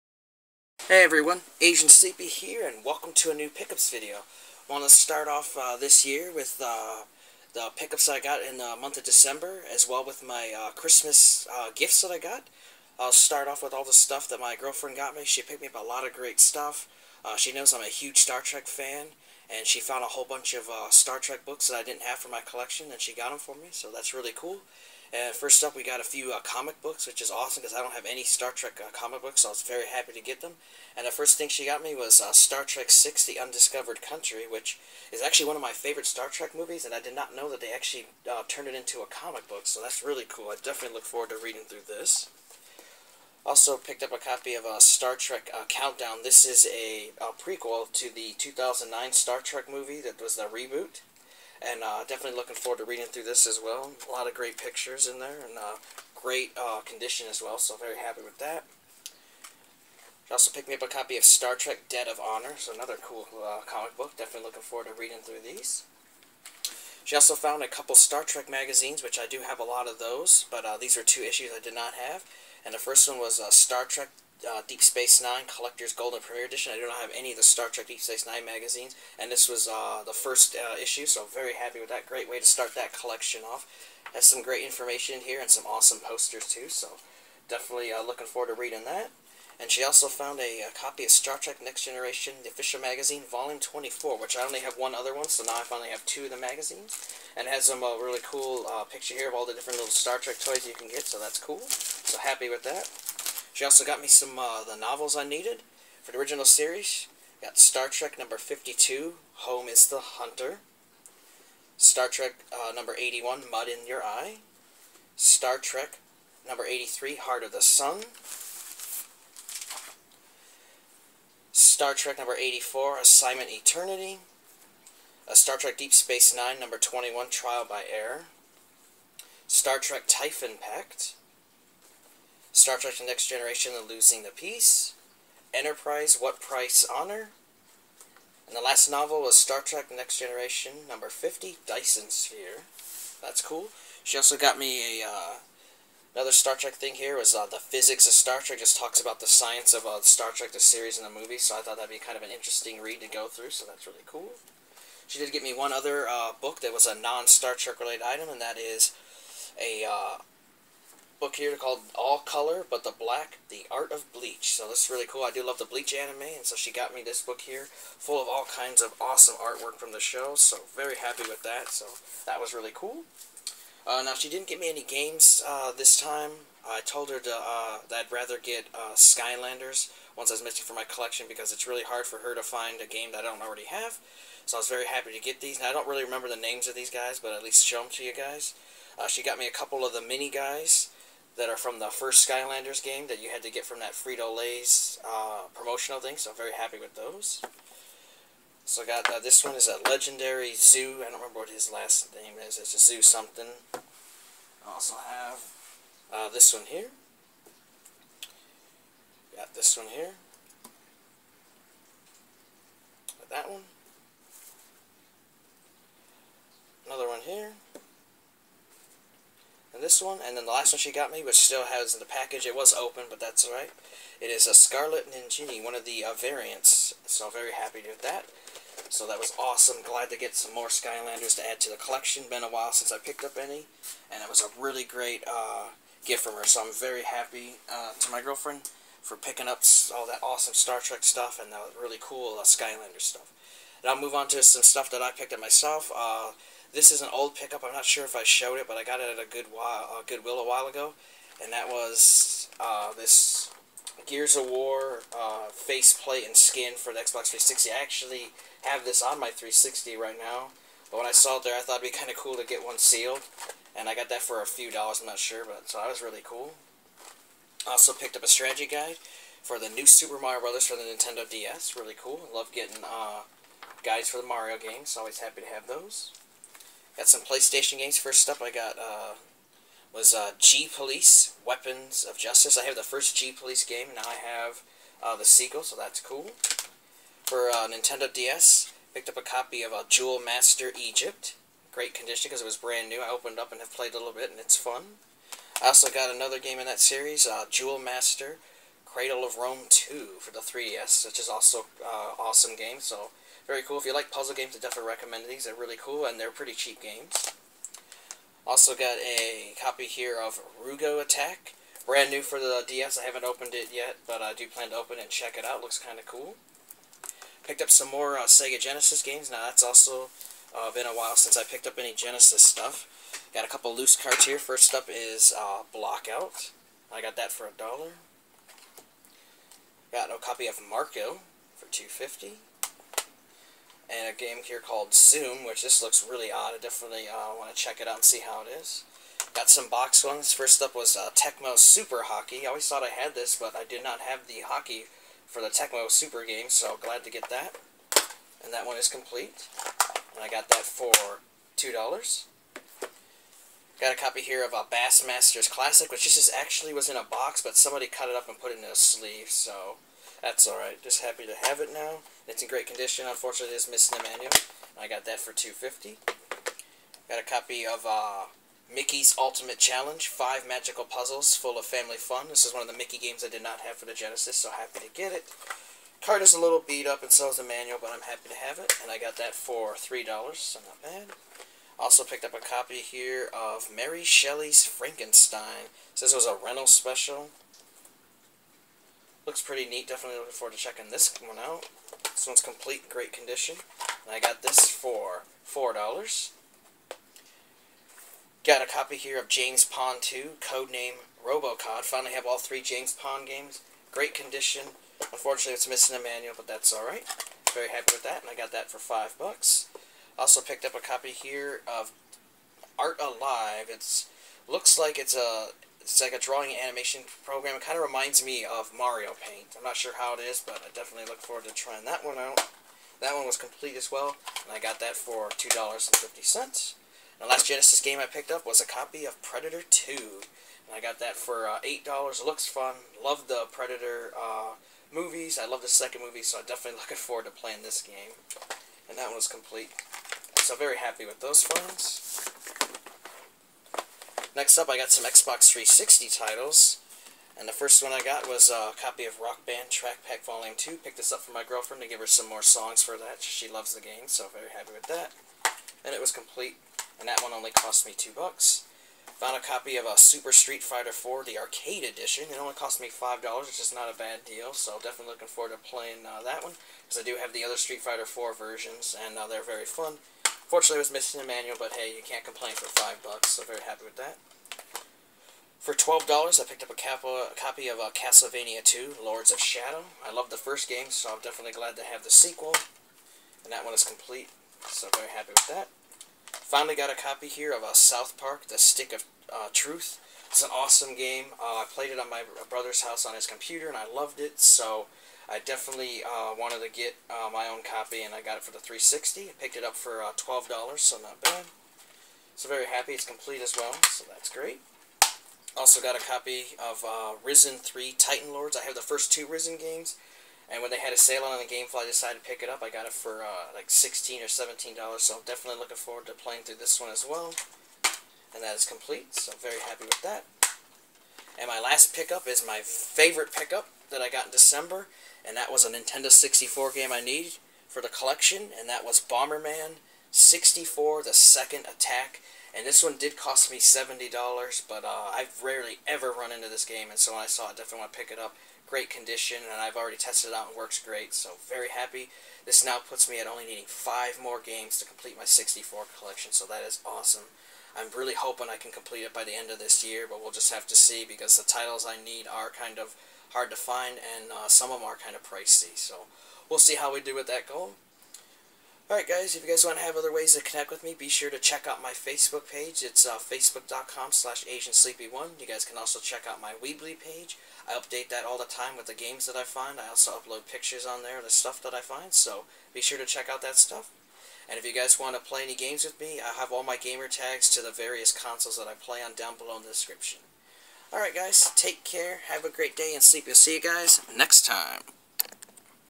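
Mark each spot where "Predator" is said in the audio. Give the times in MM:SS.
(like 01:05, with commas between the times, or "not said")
07:09, 07:13.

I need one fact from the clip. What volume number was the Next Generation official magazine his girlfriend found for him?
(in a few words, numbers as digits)
24.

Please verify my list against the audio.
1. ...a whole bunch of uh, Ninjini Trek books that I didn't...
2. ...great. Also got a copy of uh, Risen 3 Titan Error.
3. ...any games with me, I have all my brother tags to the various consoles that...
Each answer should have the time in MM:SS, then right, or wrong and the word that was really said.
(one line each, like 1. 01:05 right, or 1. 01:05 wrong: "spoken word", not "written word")
1. 00:20 wrong: "Star", not "Ninjini"
2. 08:24 wrong: "Lords", not "Error"
3. 09:35 wrong: "gamer", not "brother".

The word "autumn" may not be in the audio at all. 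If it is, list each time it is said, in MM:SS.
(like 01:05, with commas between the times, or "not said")
not said.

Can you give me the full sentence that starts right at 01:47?
Got Star Trek number 52, Home is the Hunter.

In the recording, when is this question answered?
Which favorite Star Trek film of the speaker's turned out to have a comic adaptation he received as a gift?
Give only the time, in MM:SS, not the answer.
00:32.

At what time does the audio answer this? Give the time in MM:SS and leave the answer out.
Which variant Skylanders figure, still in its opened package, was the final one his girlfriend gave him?
03:44.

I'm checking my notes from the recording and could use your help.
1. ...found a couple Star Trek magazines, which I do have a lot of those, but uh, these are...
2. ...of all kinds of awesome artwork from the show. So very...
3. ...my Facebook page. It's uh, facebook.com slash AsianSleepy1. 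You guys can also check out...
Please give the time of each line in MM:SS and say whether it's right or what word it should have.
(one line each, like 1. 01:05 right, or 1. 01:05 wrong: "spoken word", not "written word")
1. 01:07 right
2. 02:48 right
3. 09:21 right.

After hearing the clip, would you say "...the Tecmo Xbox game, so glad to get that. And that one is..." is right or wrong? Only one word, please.
wrong.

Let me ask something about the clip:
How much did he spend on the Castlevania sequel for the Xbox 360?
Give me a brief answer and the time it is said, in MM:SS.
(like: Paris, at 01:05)
$12, at 07:55.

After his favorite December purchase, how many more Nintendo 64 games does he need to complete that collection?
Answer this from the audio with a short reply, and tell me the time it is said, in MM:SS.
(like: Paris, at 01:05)
5, at 09:03.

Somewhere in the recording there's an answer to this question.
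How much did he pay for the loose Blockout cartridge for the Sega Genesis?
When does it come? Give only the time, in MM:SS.
05:27.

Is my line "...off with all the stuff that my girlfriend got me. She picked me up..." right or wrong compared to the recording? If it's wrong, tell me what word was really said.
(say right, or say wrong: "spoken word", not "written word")
right.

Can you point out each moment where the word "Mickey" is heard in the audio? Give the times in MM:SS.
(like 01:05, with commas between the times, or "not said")
06:08, 06:12.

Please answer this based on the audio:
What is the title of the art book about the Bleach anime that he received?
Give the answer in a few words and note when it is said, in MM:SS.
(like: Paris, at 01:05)
All Color, but the Black, at 02:41.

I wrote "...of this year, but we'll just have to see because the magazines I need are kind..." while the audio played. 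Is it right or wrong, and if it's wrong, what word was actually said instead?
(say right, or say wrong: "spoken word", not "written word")
wrong: "titles", not "magazines".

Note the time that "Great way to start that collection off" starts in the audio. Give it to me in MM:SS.
01:22.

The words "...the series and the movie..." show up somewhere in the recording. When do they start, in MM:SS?
02:30.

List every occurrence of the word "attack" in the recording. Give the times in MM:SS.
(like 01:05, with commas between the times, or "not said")
05:11, 08:51.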